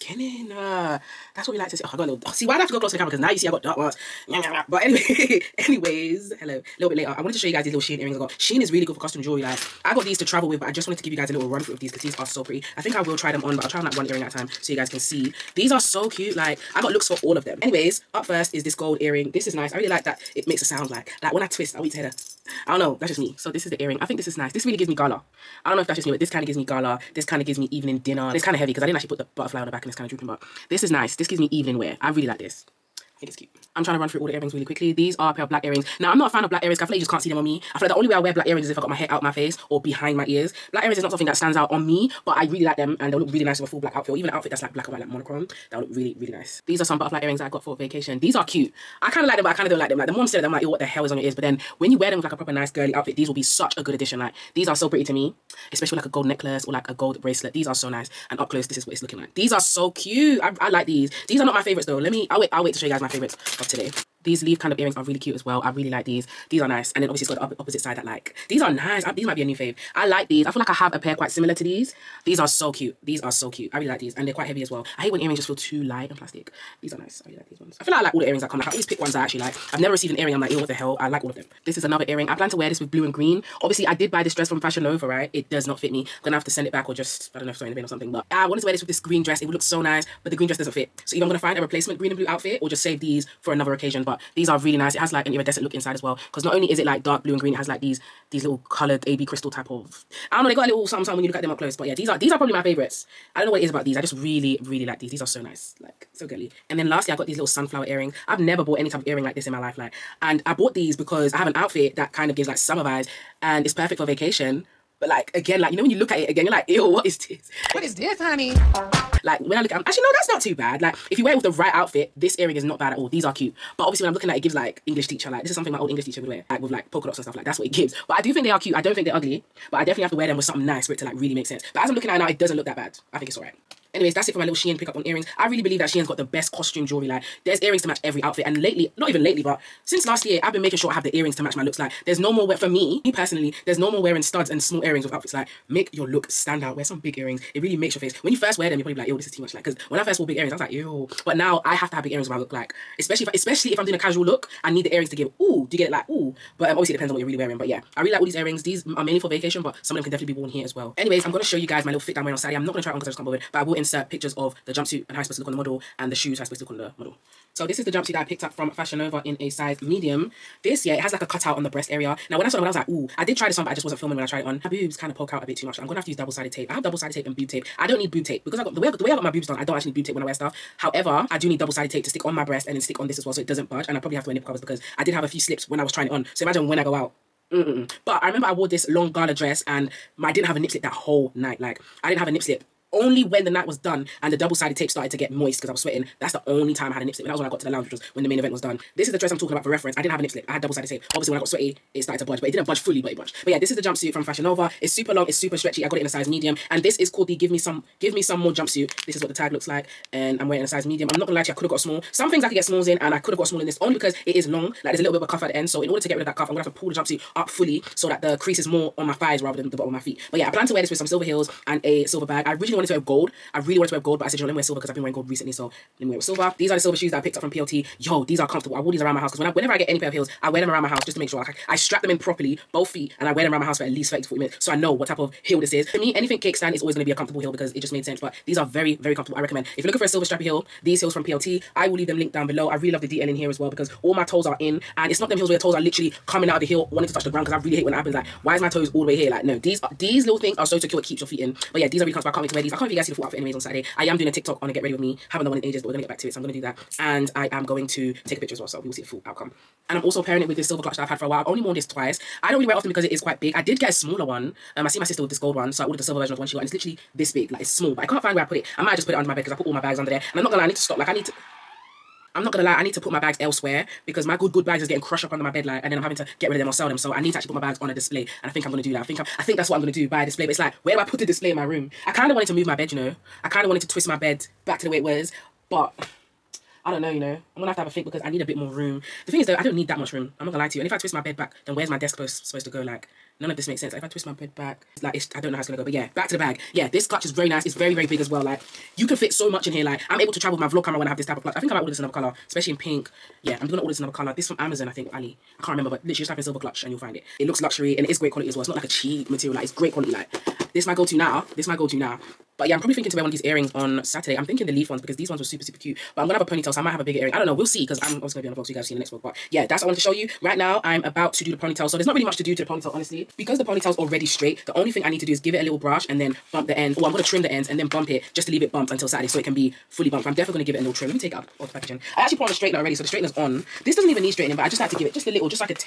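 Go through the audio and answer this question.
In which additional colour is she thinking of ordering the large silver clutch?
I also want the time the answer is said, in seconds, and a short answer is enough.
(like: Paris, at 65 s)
Pink, at 302 s.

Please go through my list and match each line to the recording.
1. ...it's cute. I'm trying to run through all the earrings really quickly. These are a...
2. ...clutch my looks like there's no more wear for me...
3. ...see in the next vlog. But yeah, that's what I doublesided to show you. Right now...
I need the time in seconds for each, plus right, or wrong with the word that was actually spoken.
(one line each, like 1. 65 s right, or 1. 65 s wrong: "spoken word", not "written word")
1. 33 s right
2. 141 s wrong: "match", not "clutch"
3. 318 s wrong: "wanted", not "doublesided".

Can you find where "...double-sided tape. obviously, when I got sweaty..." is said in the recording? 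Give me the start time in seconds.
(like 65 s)
200 s.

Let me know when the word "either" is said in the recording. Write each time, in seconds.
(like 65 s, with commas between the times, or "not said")
91 s.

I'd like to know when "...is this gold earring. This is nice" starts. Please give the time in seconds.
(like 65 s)
18 s.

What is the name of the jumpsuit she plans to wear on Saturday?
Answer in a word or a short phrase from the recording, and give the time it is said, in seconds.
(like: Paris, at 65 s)
Give me some more jumpsuit, at 208 s.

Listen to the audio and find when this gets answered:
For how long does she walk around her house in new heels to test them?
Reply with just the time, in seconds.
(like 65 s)
234 s.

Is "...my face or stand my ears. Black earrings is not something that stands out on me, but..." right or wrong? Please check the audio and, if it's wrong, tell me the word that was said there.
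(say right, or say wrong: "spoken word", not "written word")
wrong: "behind", not "stand".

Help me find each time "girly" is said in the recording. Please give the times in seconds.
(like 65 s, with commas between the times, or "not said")
52 s, 106 s.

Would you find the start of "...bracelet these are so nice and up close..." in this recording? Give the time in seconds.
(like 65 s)
57 s.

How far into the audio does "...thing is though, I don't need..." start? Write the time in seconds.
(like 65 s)
289 s.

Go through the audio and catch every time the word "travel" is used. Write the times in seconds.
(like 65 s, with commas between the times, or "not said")
10 s, 300 s.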